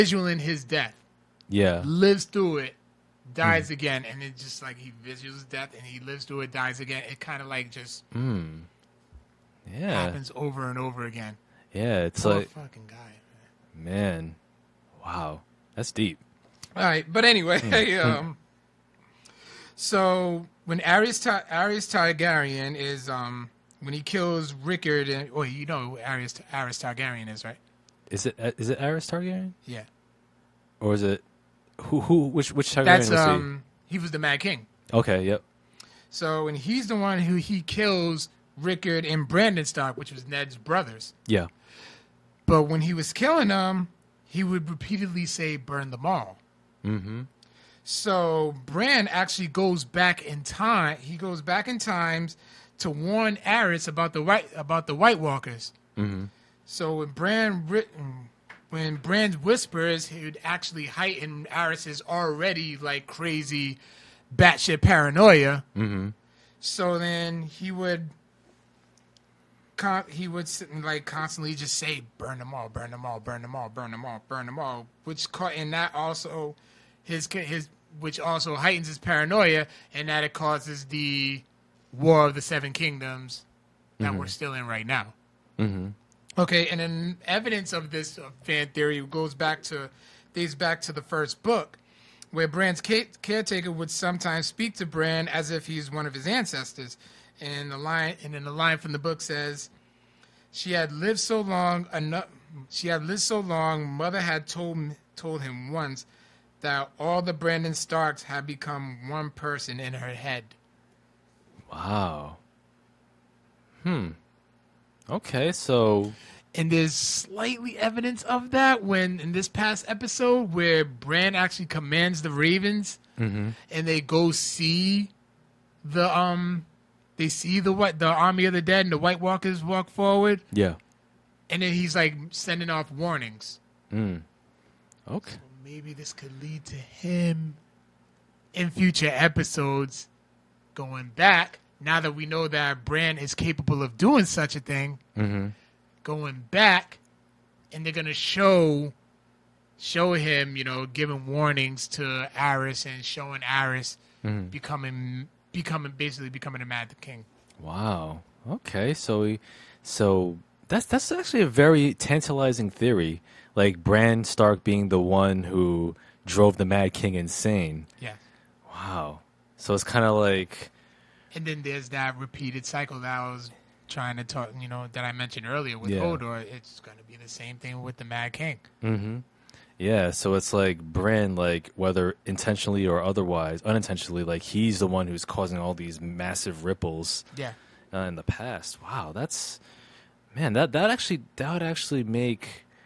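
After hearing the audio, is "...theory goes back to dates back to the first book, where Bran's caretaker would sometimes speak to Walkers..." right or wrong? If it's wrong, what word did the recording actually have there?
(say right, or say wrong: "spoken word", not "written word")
wrong: "Bran", not "Walkers".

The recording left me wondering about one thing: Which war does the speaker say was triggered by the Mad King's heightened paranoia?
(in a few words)
War of the Seven Kingdoms.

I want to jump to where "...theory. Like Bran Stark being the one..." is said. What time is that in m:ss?
2:42.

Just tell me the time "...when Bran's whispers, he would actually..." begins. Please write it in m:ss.
0:58.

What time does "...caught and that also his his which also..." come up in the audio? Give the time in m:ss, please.
1:15.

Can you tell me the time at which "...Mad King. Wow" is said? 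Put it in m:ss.
2:36.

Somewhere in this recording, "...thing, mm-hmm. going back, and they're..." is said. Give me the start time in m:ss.
2:24.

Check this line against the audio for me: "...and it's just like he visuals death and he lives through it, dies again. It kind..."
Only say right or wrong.
right.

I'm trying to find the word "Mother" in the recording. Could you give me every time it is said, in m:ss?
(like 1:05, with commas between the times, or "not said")
1:43.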